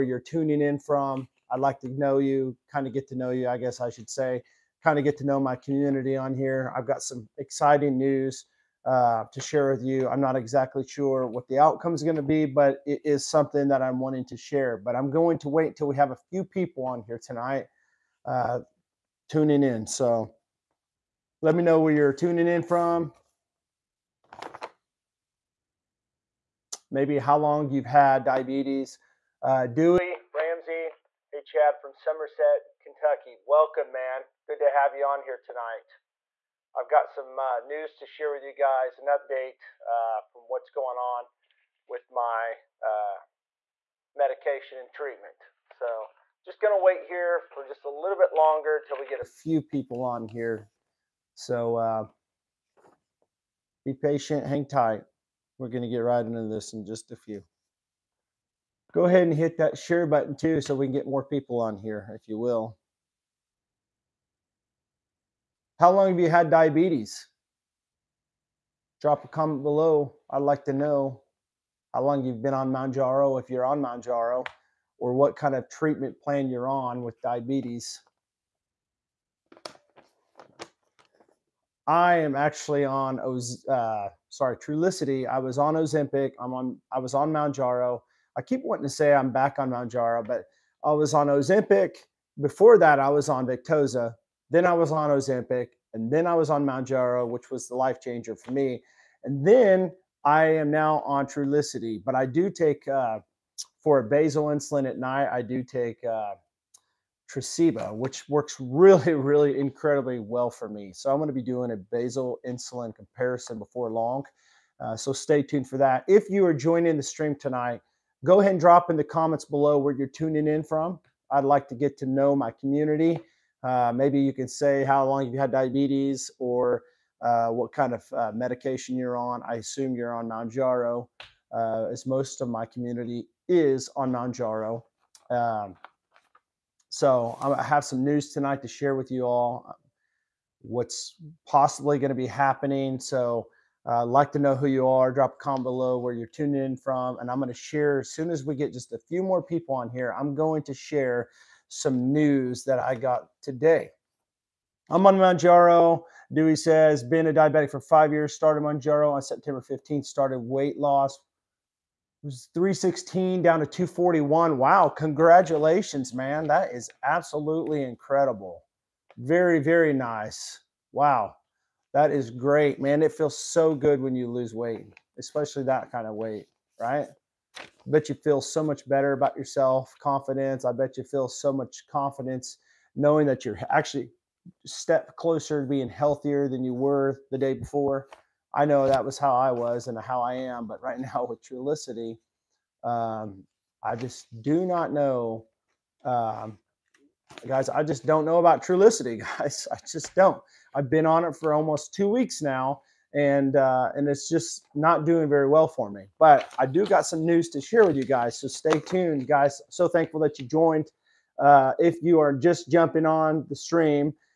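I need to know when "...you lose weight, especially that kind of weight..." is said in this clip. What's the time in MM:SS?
02:54.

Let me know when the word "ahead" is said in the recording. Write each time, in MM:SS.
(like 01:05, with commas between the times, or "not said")
00:59, 01:58.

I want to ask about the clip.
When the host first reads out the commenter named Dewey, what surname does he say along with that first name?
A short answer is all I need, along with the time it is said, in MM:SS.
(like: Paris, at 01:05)
Ramsey, at 00:30.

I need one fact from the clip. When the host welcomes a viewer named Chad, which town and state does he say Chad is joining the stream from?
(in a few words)
Somerset, Kentucky.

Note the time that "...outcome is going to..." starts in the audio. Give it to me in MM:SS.
00:11.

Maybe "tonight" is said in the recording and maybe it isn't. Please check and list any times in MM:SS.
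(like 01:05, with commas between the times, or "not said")
00:17, 00:35, 01:57, 02:18.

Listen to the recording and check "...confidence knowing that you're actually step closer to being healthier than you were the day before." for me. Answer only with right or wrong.
right.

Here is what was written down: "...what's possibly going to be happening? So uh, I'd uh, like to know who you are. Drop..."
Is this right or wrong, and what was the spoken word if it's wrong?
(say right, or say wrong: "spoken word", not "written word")
right.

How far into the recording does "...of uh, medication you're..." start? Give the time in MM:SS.
02:07.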